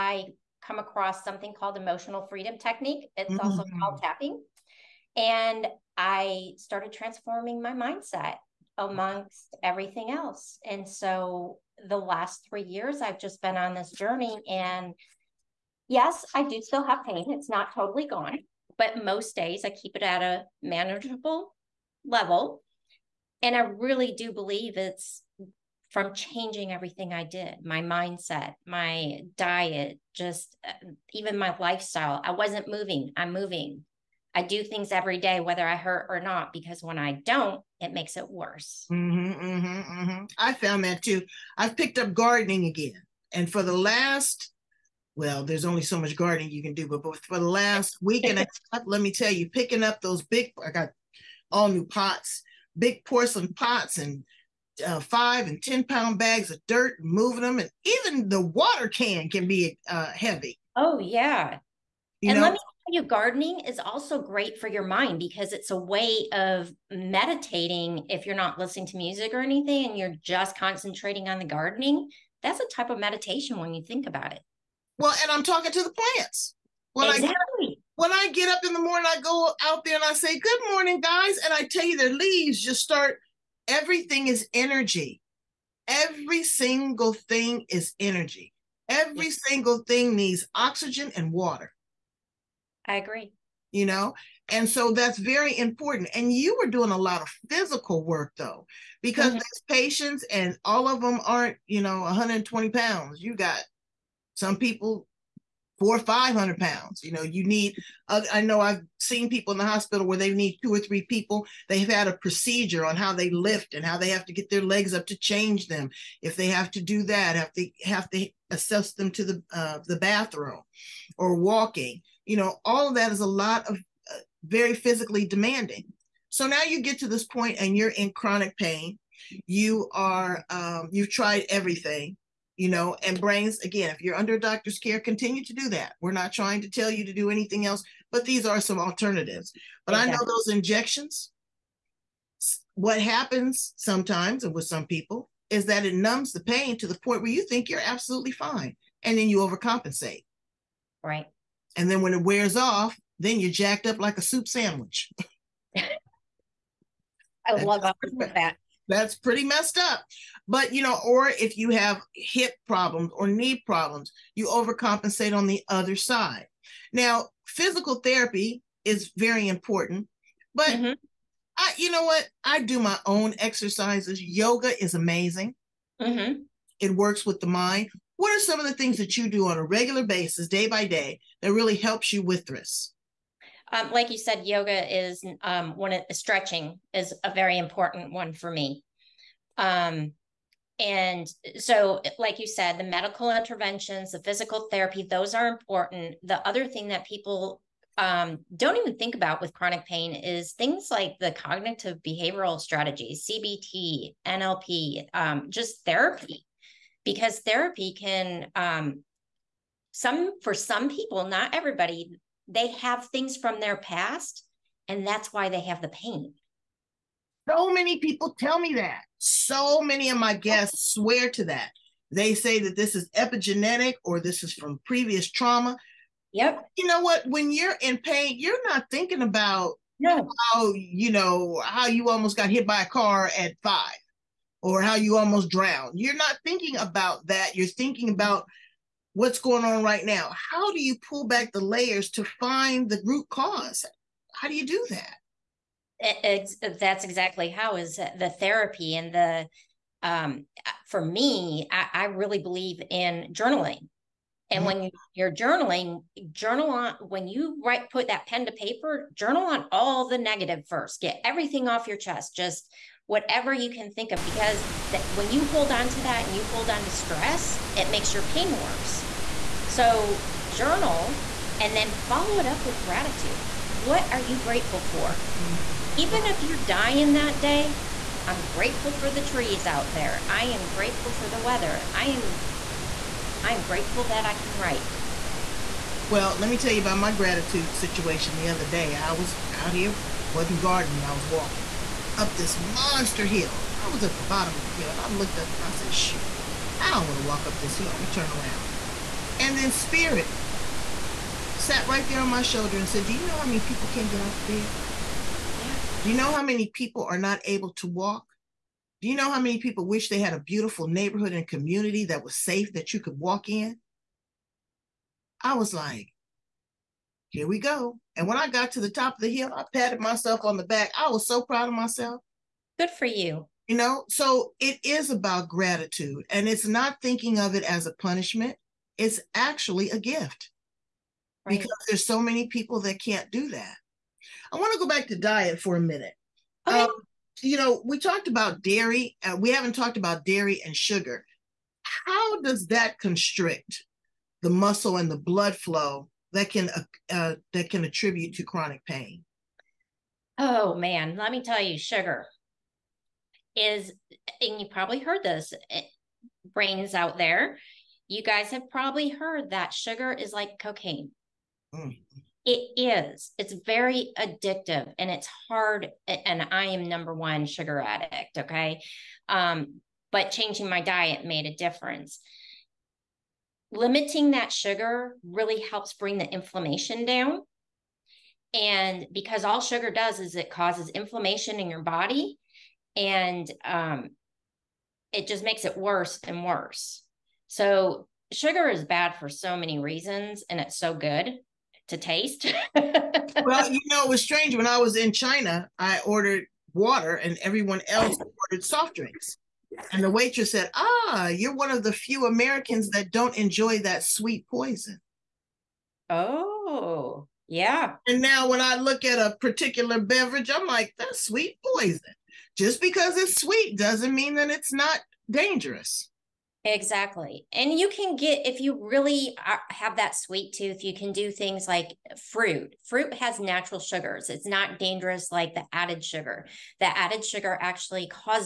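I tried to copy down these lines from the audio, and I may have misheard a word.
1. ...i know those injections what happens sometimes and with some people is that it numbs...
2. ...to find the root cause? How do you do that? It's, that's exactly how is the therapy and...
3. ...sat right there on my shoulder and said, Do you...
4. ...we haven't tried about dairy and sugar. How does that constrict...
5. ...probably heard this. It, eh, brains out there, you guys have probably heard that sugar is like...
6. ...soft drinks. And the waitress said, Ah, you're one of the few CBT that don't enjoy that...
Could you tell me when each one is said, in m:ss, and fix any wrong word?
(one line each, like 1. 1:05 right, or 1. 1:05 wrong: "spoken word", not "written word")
1. 2:19 right
2. 4:02 right
3. 5:01 right
4. 5:39 wrong: "talked", not "tried"
5. 5:54 right
6. 6:38 wrong: "Americans", not "CBT".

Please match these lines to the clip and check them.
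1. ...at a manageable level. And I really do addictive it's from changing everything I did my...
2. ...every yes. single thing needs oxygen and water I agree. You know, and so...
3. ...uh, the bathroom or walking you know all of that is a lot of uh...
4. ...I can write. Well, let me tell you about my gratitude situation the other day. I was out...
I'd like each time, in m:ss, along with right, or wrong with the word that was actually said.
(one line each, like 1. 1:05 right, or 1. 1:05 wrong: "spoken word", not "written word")
1. 0:20 wrong: "believe", not "addictive"
2. 1:28 right
3. 1:59 right
4. 4:44 right.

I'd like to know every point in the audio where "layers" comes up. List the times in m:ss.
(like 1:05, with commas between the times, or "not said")
4:01.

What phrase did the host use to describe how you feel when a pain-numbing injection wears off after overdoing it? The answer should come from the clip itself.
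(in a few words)
jacked up like a soup sandwich.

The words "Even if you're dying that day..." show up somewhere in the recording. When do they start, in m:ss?
4:35.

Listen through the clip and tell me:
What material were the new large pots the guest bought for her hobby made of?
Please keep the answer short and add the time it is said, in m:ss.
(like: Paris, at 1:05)
porcelain, at 0:53.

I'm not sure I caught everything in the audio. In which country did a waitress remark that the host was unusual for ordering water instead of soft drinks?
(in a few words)
China.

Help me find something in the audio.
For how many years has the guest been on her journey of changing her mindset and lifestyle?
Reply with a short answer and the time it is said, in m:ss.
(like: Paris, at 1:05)
3, at 0:12.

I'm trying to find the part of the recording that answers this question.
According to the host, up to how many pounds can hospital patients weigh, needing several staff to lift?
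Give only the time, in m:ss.
1:45.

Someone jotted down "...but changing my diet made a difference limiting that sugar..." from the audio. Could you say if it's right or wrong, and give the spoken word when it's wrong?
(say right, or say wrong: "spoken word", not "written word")
right.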